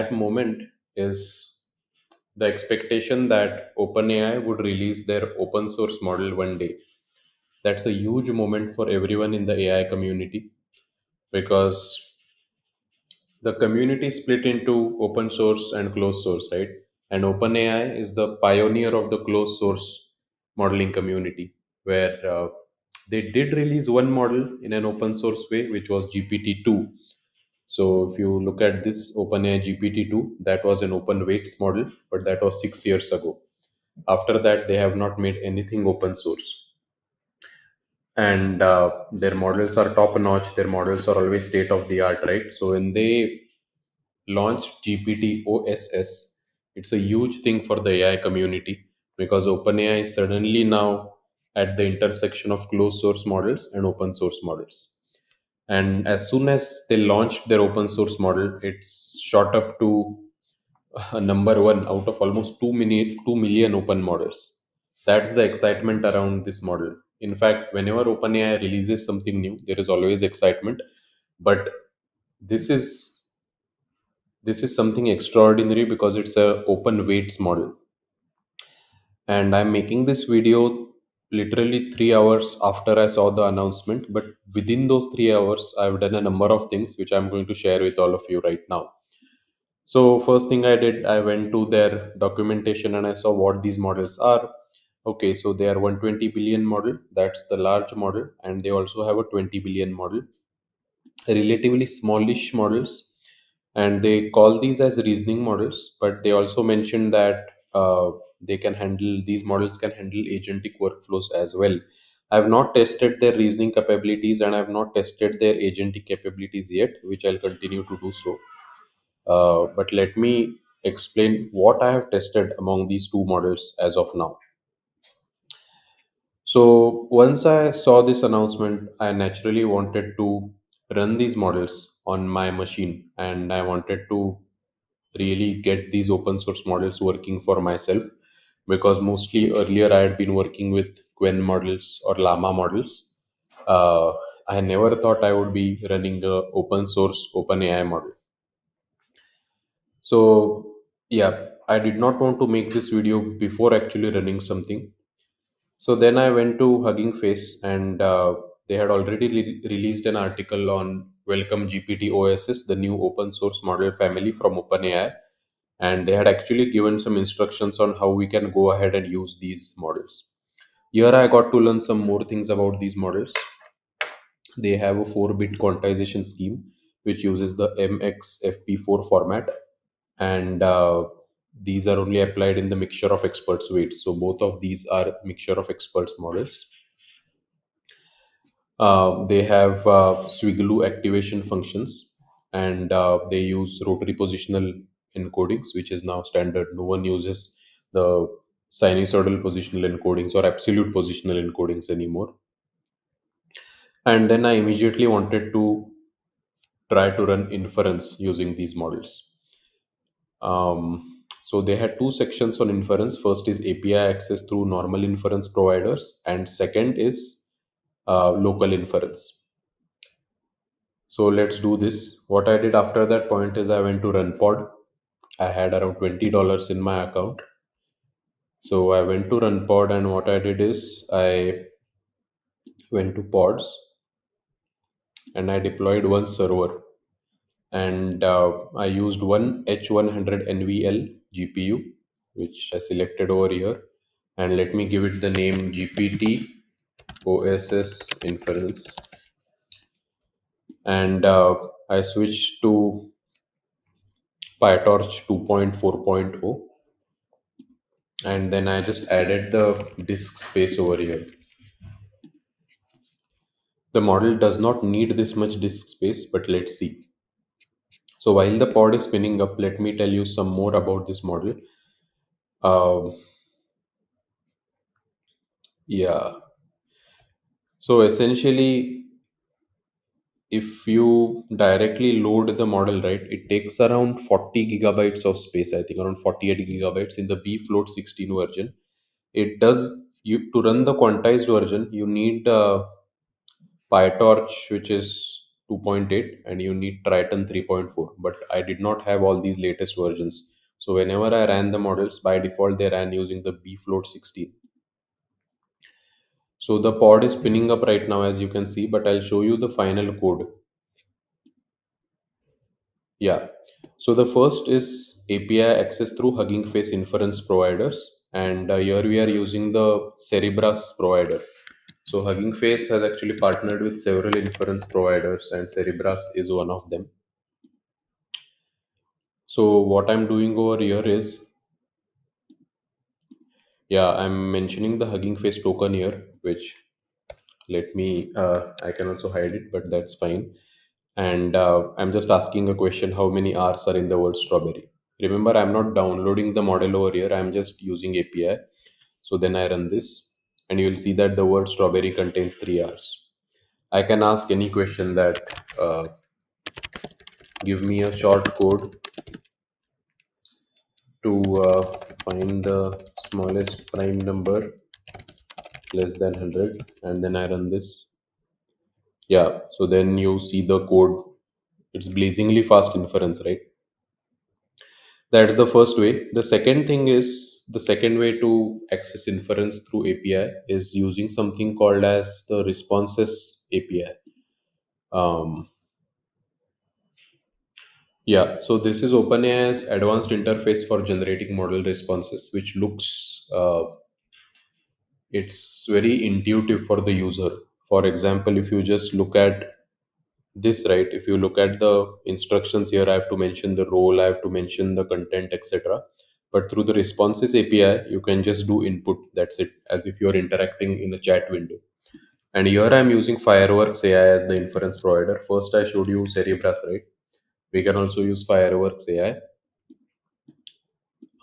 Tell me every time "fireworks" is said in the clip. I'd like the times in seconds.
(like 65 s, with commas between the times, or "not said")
413 s, 418 s.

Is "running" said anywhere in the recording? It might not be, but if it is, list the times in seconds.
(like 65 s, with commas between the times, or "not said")
145 s, 154 s.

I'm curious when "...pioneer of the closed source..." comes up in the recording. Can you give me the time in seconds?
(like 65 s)
18 s.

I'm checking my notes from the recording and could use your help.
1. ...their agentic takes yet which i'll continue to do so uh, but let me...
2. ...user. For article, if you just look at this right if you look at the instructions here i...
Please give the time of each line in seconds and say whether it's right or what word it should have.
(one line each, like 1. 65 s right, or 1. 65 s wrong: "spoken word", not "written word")
1. 115 s wrong: "capabilities", not "takes"
2. 397 s wrong: "example", not "article".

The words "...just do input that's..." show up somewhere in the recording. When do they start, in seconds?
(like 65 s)
408 s.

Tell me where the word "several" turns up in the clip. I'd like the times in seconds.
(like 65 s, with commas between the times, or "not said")
324 s.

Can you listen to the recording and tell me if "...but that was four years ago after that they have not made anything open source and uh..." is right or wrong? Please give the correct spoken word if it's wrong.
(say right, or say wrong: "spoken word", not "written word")
wrong: "six", not "four".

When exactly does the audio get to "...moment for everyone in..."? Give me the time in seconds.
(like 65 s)
8 s.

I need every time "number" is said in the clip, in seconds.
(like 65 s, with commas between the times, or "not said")
61 s, 86 s, 364 s.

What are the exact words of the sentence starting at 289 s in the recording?
It does, you to run the quantized version, you need a PyTorch, which is 2.8 and you need Triton 3.4.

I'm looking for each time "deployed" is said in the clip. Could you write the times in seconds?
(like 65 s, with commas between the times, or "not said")
235 s.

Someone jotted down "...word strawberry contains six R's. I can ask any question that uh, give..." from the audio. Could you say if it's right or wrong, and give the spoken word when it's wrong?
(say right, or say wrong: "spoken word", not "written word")
wrong: "three", not "six".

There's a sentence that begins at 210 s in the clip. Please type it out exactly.
Um, so they had two sections on inference.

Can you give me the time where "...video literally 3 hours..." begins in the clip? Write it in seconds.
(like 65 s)
80 s.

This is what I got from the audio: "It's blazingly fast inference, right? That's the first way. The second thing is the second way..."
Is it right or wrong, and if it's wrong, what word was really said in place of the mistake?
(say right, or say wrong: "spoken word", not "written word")
right.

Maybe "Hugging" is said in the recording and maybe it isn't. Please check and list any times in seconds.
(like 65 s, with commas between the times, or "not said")
156 s, 316 s, 322 s, 335 s.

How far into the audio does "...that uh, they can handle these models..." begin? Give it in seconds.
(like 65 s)
107 s.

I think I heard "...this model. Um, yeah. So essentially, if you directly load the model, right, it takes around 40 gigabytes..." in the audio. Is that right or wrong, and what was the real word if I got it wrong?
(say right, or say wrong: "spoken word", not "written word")
right.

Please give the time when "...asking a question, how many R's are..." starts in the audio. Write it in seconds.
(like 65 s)
342 s.